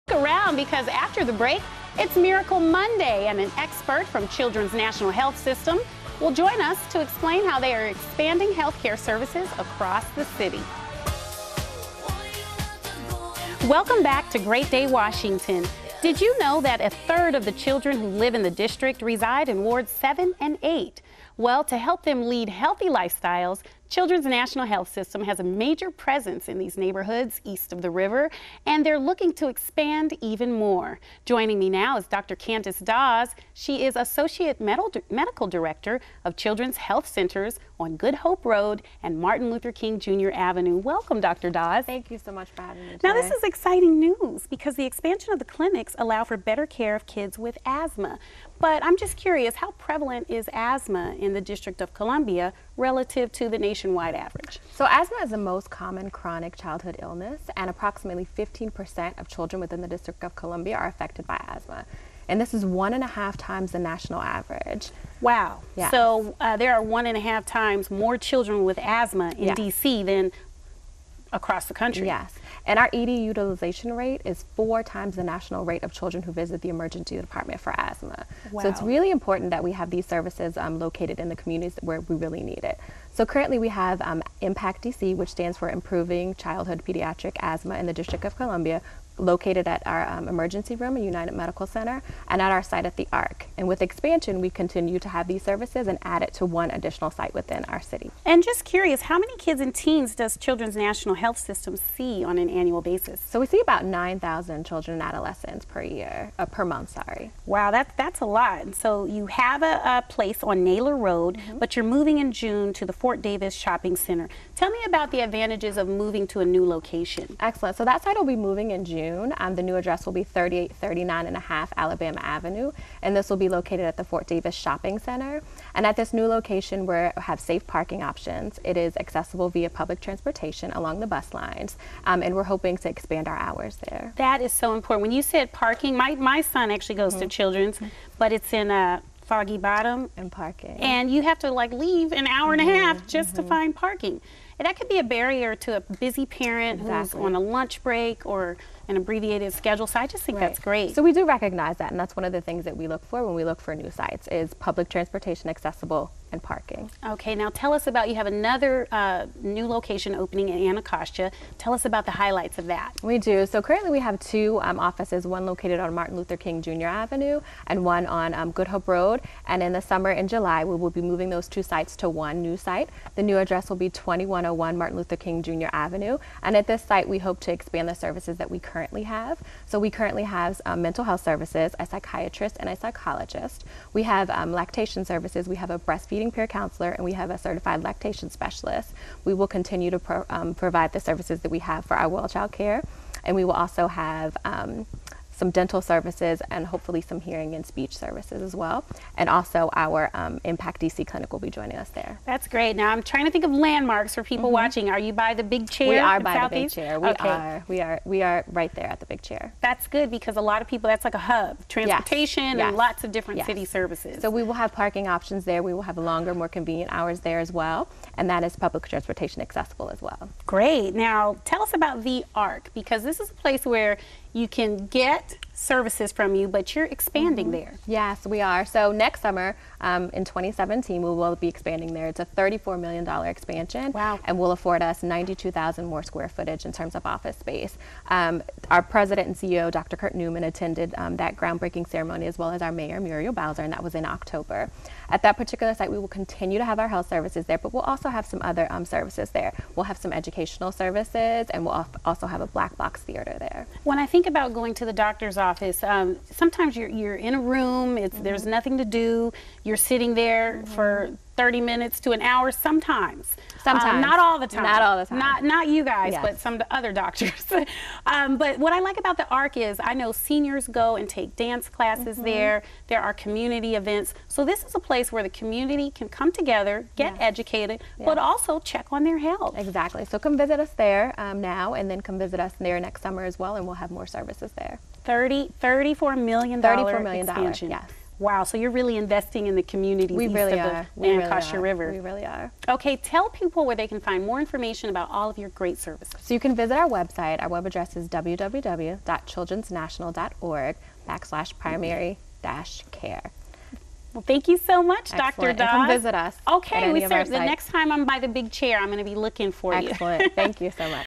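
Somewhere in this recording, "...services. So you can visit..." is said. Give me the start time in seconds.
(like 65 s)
295 s.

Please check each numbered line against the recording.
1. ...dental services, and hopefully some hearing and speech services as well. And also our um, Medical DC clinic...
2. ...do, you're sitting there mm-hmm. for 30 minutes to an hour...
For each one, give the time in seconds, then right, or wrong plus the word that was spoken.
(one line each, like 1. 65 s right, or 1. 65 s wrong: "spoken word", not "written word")
1. 195 s wrong: "Impact", not "Medical"
2. 258 s right.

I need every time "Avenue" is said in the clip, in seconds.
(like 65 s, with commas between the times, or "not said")
40 s, 122 s, 166 s, 175 s.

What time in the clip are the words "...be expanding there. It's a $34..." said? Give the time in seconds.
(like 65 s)
231 s.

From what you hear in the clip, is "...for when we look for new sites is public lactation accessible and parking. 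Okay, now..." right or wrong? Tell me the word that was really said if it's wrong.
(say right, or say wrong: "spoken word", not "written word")
wrong: "transportation", not "lactation".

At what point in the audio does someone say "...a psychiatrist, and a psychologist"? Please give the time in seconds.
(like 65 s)
181 s.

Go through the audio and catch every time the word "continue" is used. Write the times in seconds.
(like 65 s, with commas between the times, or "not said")
94 s, 189 s, 246 s.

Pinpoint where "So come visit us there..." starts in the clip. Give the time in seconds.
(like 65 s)
280 s.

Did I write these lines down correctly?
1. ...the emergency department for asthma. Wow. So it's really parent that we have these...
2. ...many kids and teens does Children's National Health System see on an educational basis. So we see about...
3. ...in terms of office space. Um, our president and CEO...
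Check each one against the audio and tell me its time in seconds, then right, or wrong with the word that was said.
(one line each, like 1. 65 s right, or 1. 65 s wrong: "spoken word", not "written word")
1. 76 s wrong: "important", not "parent"
2. 99 s wrong: "annual", not "educational"
3. 236 s right.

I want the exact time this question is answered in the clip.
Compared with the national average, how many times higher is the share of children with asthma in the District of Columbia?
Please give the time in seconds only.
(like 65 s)
62 s.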